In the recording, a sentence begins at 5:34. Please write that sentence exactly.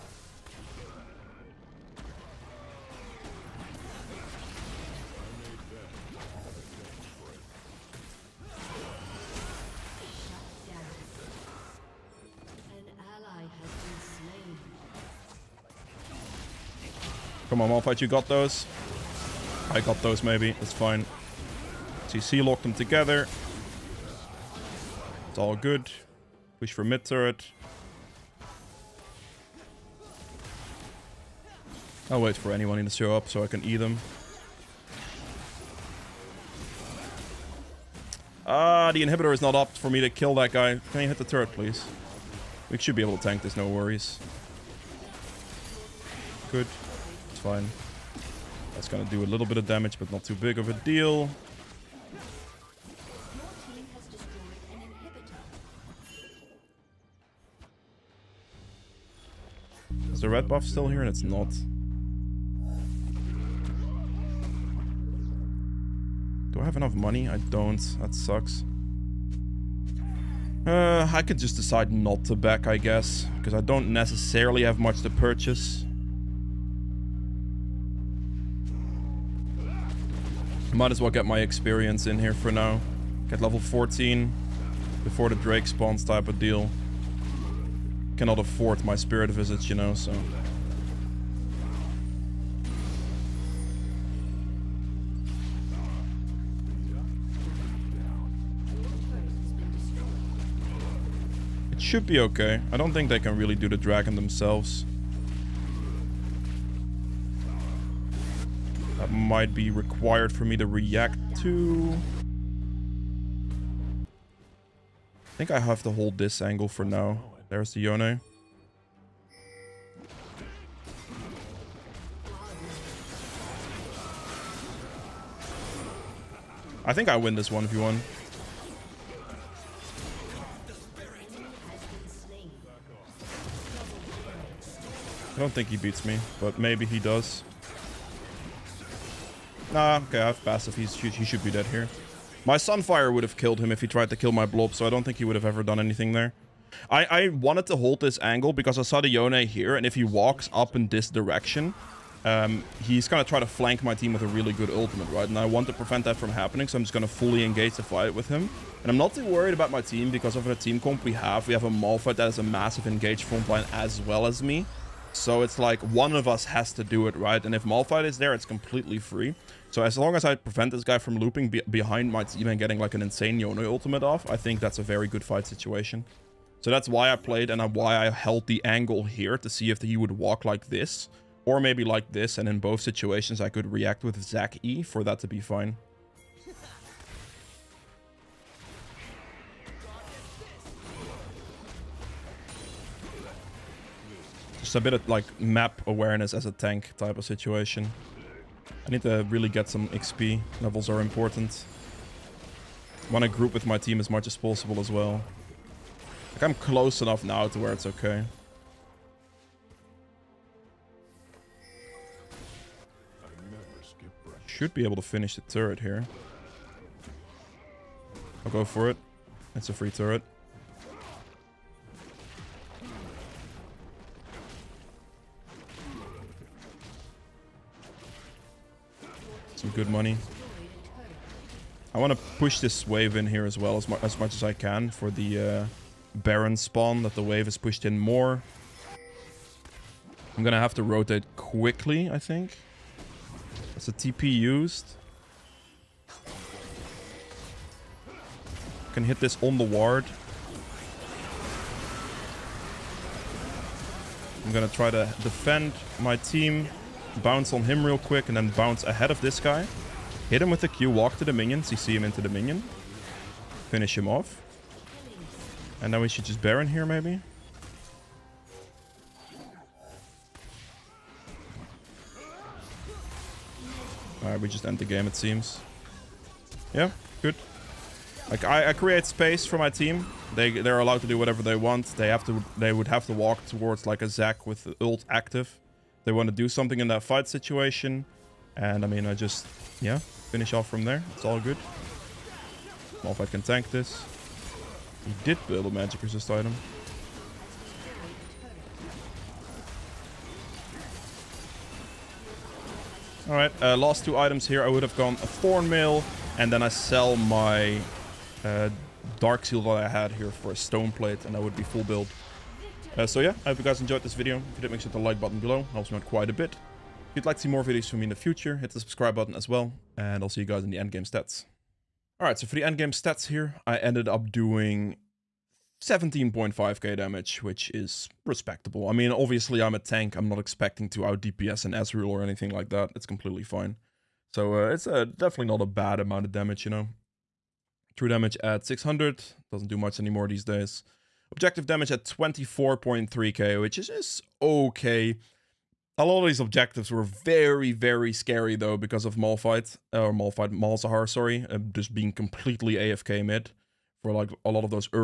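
So uh, it's uh, definitely not a bad amount of damage, you know.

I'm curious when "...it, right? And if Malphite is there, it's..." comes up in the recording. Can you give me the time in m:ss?
2:47.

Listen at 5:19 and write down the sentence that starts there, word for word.
And I'll see you guys in the endgame stats.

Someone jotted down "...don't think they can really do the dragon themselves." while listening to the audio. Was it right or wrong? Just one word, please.
right.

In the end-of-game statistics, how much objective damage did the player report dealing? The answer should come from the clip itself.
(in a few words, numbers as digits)
24.3k.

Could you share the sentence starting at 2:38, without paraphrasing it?
And I'm not too worried about my team because of the team comp we have.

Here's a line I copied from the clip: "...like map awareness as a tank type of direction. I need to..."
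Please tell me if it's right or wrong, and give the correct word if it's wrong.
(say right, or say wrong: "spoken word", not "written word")
wrong: "situation", not "direction".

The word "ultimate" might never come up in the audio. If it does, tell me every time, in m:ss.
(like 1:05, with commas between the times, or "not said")
2:34, 2:53.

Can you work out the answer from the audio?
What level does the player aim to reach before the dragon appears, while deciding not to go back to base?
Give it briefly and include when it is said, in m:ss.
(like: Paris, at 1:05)
Level 14, at 1:23.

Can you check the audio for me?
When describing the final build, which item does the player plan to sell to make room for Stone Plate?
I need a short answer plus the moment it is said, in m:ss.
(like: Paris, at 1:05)
Dark Seal, at 5:09.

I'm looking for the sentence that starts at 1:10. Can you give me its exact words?
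Uh, I could just decide not to back, I guess.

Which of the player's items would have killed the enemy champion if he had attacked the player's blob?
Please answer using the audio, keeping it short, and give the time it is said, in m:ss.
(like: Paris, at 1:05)
Sunfire, at 2:22.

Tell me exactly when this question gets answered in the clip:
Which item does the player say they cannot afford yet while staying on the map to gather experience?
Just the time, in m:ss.
1:28.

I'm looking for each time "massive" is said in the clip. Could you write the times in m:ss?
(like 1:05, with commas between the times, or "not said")
2:42.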